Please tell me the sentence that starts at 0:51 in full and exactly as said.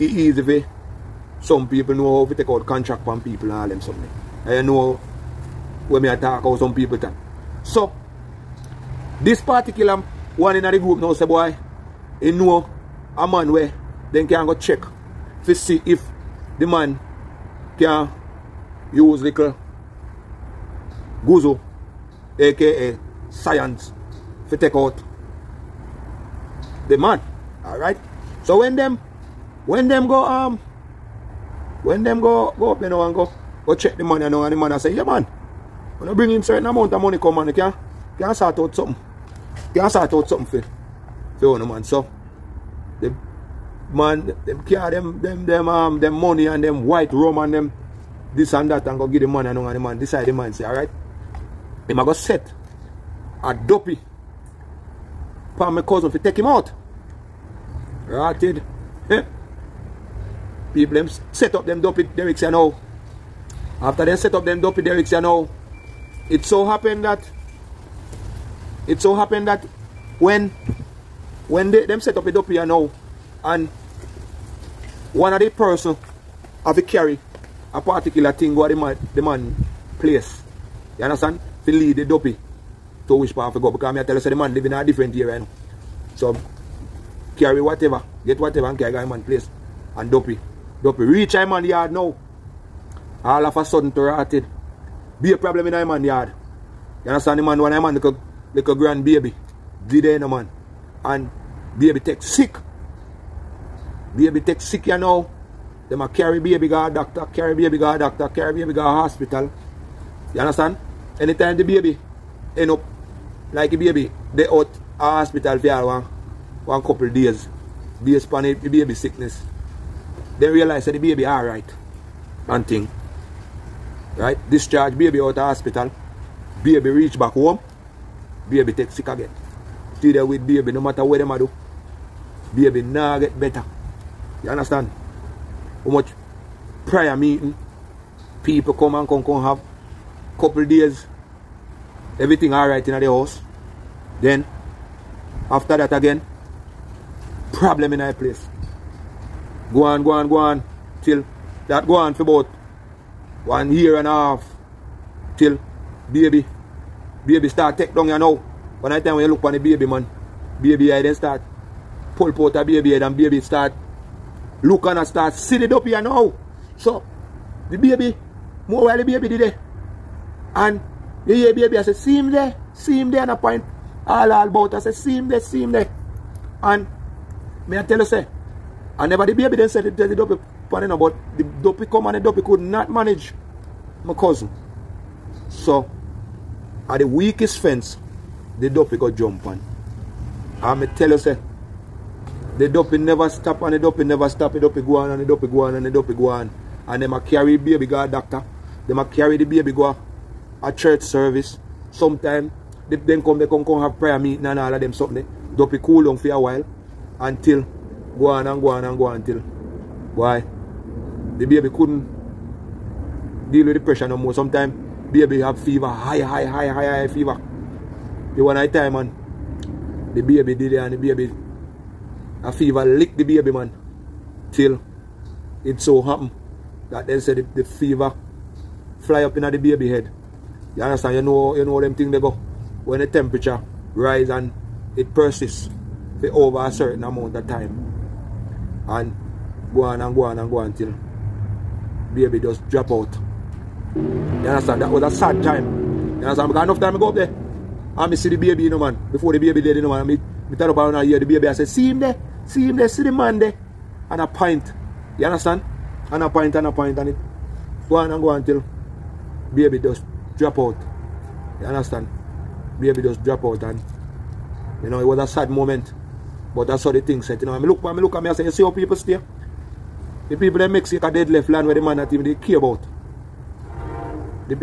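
They a go set a duppy for my cousin to take him out.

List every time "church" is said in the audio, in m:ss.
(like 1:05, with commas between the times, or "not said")
3:20.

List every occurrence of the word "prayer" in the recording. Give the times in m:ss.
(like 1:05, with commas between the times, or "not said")
2:16, 3:23.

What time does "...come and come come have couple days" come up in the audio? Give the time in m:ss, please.
2:18.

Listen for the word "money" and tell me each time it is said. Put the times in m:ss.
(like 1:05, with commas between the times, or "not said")
0:36, 0:46.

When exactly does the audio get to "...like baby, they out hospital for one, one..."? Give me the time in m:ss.
1:53.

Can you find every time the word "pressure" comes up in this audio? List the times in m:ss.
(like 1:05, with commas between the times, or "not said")
3:33.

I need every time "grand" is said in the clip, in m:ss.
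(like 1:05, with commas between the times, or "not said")
1:38.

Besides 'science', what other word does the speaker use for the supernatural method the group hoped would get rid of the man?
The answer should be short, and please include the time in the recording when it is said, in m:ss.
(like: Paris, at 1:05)
guzo, at 0:21.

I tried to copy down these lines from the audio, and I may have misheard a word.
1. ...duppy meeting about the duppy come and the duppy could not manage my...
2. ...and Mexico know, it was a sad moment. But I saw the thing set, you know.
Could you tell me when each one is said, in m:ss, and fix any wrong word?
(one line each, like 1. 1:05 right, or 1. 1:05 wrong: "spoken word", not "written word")
1. 3:00 wrong: "panning", not "meeting"
2. 4:23 wrong: "You", not "Mexico".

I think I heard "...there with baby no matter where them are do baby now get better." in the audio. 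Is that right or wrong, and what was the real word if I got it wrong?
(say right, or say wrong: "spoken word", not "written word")
right.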